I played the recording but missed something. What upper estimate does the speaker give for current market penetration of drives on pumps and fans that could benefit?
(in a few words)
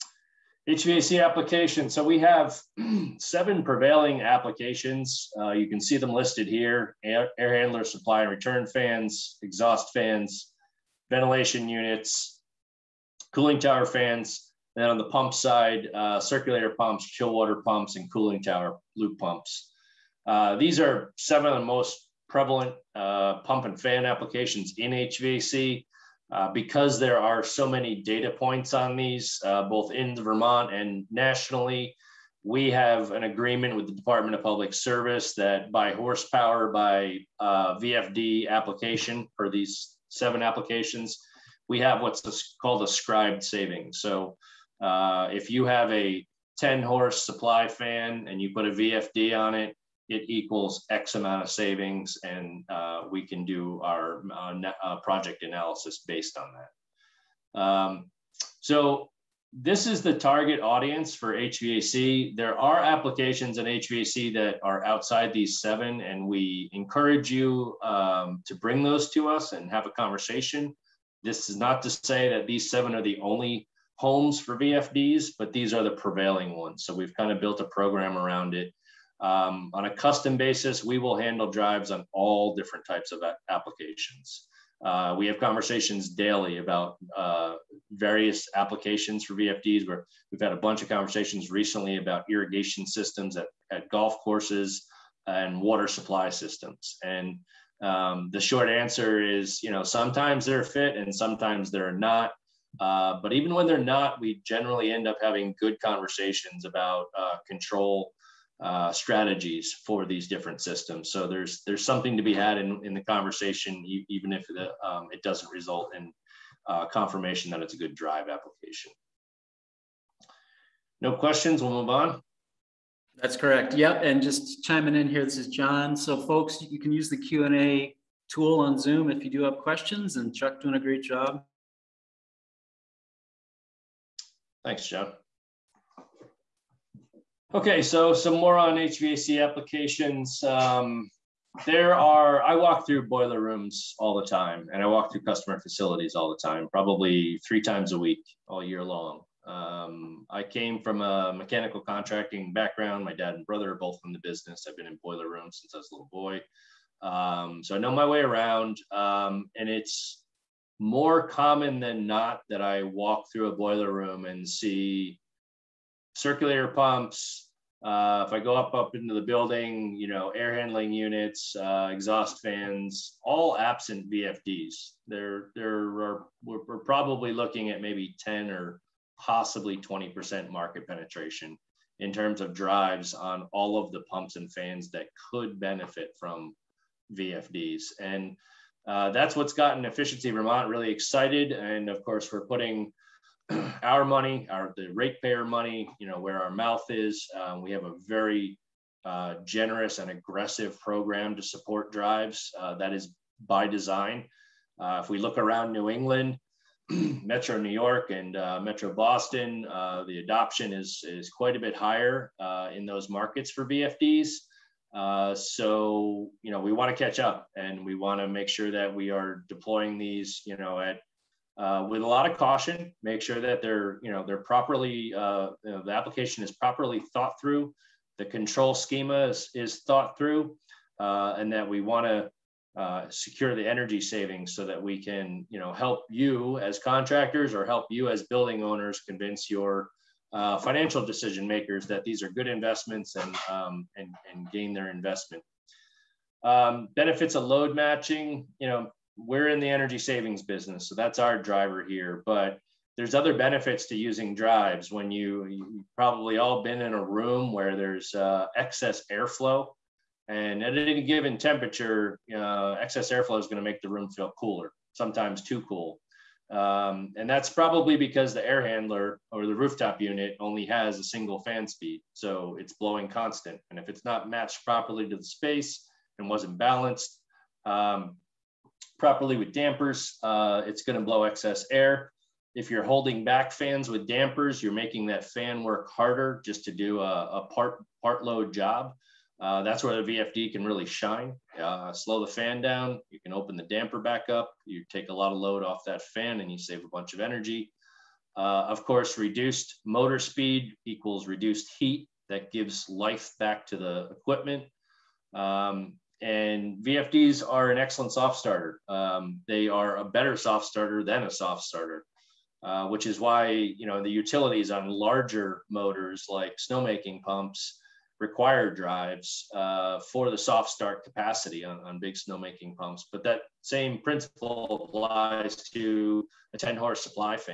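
20%.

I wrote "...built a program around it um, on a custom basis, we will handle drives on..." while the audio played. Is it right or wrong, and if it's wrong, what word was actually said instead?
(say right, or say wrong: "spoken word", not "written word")
right.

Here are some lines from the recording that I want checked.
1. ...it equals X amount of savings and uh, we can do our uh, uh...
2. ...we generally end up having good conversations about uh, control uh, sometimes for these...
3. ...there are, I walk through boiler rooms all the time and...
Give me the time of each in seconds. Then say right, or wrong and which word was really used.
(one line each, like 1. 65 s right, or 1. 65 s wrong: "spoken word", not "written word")
1. 50 s right
2. 104 s wrong: "strategies", not "sometimes"
3. 141 s right.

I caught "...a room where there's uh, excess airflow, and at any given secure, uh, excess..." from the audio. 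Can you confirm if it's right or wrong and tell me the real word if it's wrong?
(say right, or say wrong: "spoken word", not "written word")
wrong: "temperature", not "secure".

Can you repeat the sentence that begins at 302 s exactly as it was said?
That gives life back to the equipment.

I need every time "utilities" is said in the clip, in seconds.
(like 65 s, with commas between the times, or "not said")
314 s.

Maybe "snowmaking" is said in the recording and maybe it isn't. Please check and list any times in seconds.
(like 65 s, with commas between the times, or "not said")
316 s, 322 s.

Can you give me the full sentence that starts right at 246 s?
Um, benefits of load matching, you know, we're in the energy savings business, so that's our driver here.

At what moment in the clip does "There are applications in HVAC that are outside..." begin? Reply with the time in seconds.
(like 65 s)
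62 s.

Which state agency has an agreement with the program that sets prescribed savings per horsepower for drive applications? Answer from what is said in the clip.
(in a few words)
Department of Public Service.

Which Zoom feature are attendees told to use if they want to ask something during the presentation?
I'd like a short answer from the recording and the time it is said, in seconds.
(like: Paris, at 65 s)
Q&A tool, at 127 s.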